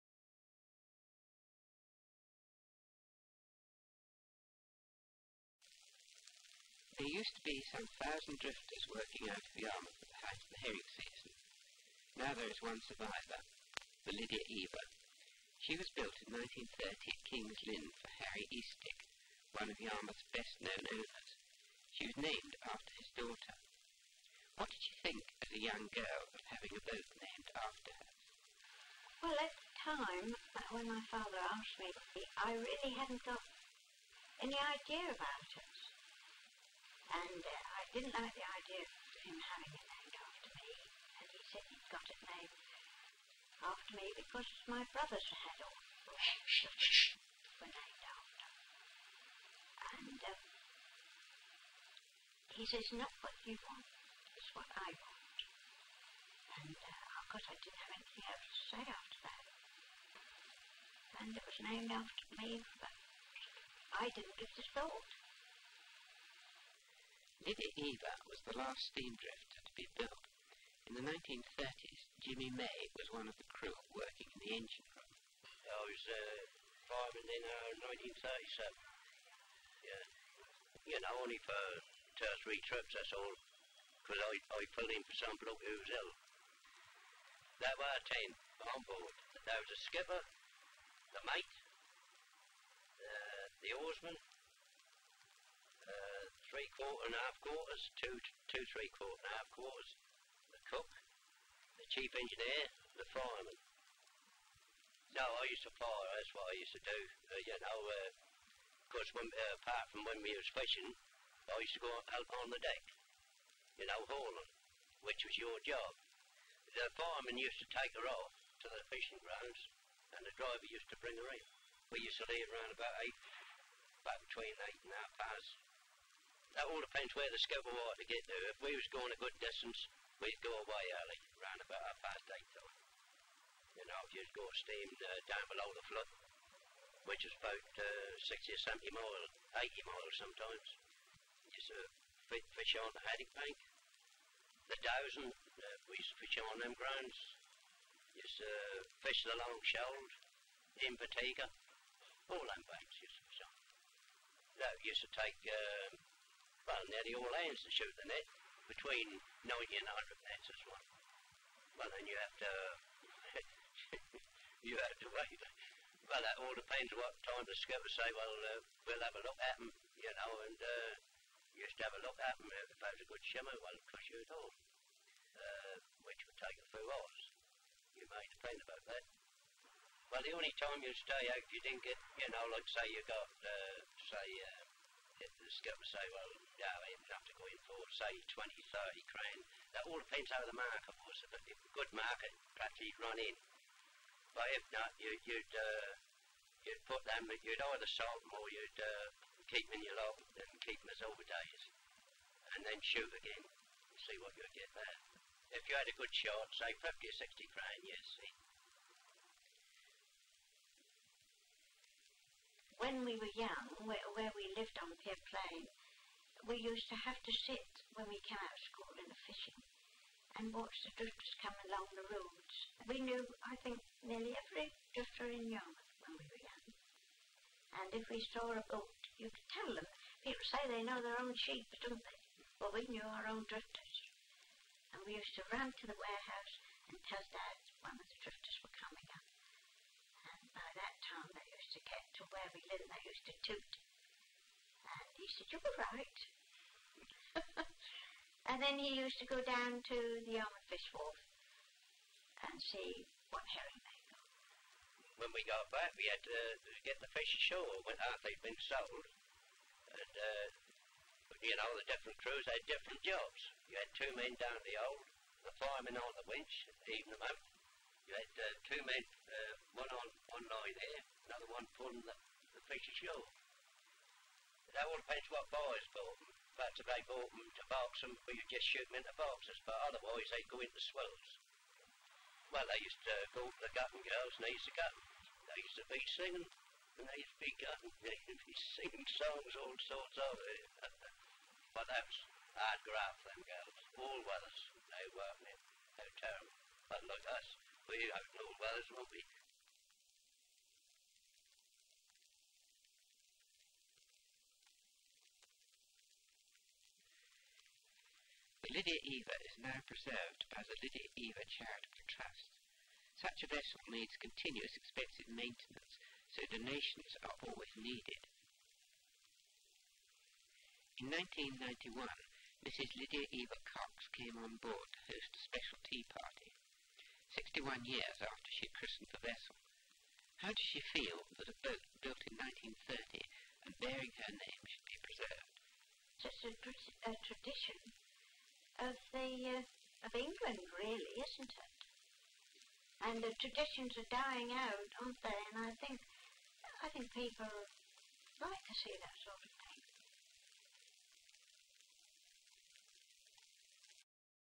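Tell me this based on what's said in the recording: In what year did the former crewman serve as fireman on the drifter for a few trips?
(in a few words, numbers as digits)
1937.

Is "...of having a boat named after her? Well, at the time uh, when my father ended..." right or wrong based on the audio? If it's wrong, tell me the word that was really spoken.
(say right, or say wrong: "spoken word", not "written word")
wrong: "asked", not "ended".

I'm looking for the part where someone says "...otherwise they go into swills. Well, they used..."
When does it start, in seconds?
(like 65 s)
279 s.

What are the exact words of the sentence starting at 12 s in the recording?
Now there is one survivor, the Lydia Eva.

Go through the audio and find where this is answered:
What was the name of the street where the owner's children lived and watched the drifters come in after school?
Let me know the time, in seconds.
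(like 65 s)
215 s.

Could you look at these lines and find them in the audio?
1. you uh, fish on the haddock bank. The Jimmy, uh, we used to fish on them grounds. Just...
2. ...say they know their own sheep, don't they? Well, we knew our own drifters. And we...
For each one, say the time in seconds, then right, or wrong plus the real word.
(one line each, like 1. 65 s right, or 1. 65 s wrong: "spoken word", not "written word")
1. 141 s wrong: "Dowsing", not "Jimmy"
2. 230 s right.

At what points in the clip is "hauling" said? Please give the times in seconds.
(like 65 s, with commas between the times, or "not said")
114 s.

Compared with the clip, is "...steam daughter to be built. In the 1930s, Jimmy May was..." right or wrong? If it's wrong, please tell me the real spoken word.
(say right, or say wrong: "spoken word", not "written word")
wrong: "drifter", not "daughter".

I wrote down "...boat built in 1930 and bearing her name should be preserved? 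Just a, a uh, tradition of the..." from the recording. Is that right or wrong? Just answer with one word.
right.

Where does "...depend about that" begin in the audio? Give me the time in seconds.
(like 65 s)
178 s.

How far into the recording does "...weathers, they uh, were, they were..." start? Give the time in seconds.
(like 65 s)
294 s.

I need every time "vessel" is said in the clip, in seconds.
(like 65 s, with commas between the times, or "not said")
313 s, 329 s.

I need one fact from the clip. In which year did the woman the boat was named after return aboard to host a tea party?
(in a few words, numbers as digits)
1991.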